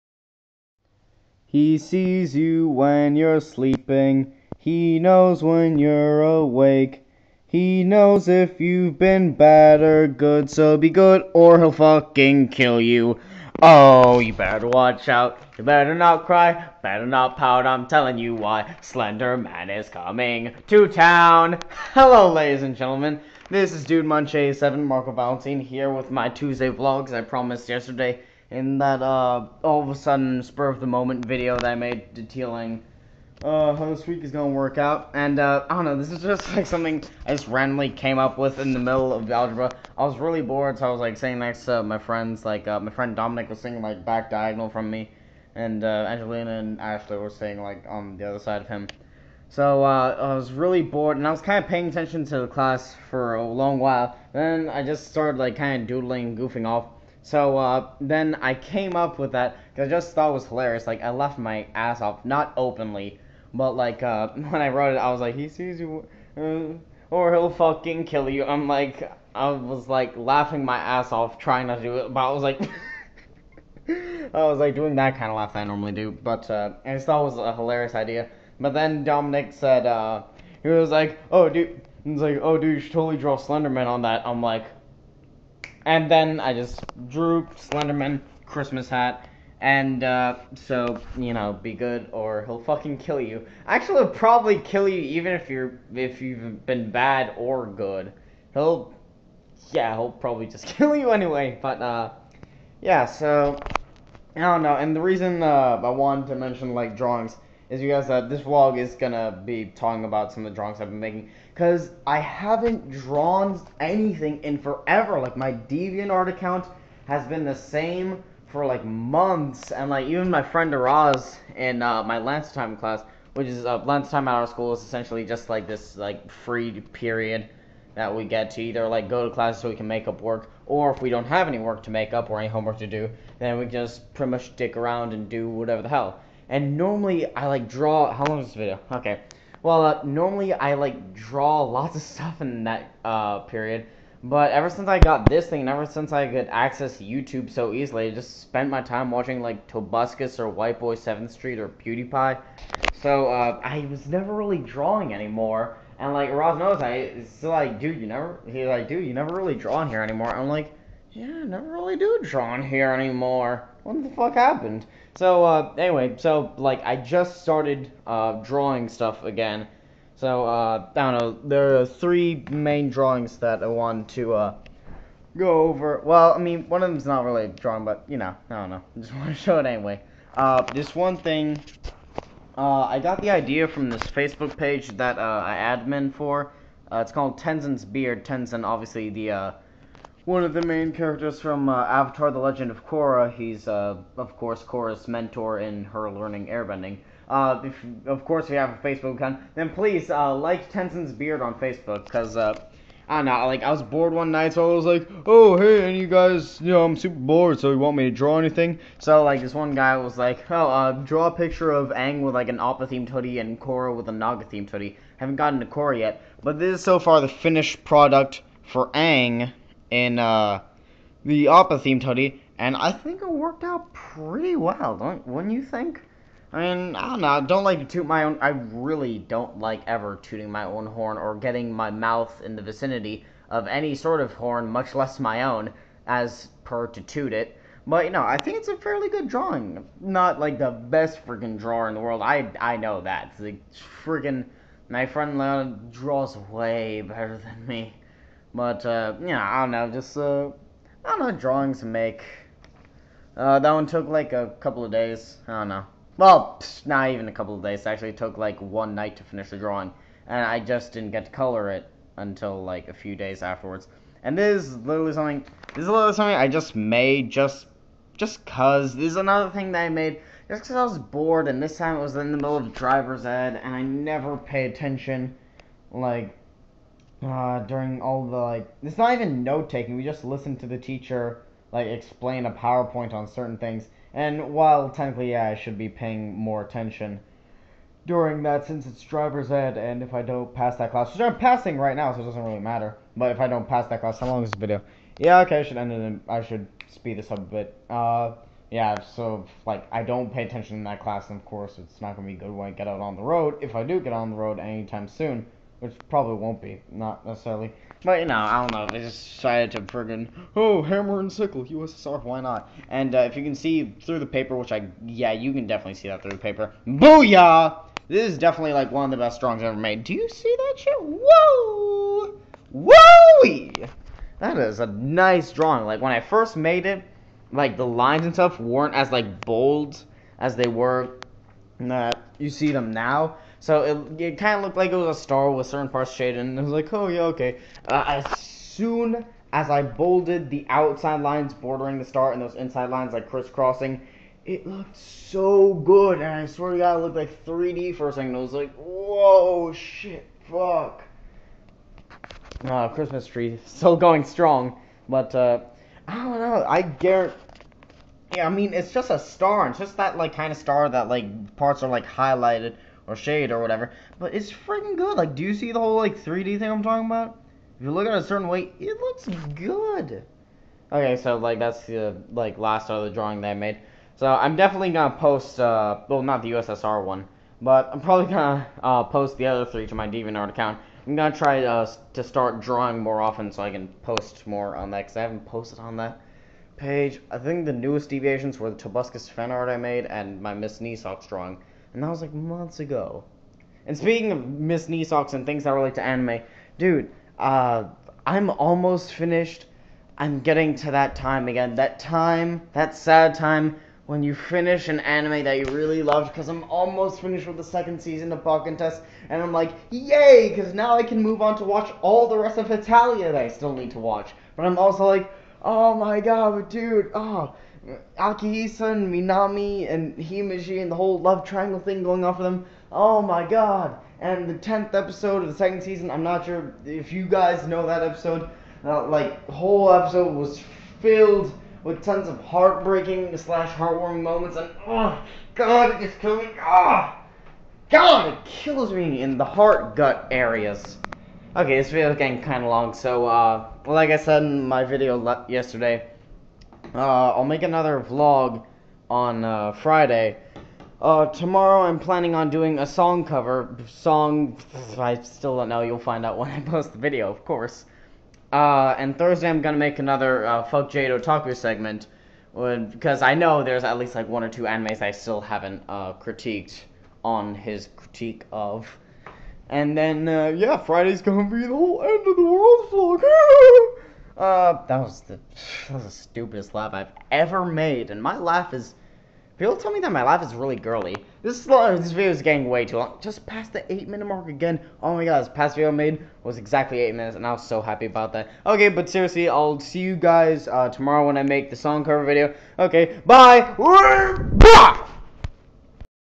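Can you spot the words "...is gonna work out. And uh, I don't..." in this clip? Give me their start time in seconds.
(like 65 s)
34 s.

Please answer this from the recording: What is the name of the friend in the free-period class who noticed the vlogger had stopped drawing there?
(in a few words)
Araz.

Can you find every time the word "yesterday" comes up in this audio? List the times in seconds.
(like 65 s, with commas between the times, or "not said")
27 s, 445 s.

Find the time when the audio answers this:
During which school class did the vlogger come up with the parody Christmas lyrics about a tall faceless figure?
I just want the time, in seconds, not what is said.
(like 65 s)
39 s.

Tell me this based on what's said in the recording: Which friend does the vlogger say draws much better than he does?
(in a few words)
Leon.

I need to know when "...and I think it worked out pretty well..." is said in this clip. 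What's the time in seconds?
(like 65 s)
222 s.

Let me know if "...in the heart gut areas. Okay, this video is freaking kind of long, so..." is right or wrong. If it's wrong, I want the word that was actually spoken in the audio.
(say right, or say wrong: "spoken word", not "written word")
wrong: "getting", not "freaking".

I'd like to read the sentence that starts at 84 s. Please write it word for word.
I'm like, and then I just drew Slenderman Christmas hat.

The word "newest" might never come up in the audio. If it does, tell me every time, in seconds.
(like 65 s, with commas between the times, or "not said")
387 s.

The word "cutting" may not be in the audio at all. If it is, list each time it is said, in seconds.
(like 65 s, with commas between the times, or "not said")
not said.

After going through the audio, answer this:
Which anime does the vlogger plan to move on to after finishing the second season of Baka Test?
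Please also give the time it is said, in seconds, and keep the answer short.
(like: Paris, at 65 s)
Hetalia, at 412 s.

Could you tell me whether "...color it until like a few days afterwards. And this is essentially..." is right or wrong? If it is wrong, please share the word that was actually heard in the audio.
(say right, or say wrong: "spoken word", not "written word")
wrong: "literally", not "essentially".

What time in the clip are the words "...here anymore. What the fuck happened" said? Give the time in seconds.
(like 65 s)
162 s.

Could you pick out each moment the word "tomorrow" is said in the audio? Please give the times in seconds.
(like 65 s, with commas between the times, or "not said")
451 s, 490 s.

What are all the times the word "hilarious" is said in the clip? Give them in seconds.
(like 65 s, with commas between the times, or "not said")
60 s, 77 s.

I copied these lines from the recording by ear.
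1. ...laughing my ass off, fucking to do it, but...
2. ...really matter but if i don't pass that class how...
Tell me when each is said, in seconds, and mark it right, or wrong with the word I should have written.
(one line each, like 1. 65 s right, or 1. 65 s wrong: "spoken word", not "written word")
1. 70 s wrong: "trying", not "fucking"
2. 292 s right.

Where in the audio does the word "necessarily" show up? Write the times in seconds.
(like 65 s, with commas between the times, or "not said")
307 s.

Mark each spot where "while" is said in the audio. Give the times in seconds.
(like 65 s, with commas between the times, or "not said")
53 s, 284 s.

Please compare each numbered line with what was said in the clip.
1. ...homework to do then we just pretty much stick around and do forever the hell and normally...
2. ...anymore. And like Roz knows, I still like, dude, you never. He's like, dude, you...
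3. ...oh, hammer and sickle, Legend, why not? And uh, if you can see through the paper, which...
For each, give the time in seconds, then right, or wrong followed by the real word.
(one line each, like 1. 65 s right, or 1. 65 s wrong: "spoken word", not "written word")
1. 132 s wrong: "whatever", not "forever"
2. 155 s right
3. 310 s wrong: "USSR", not "Legend".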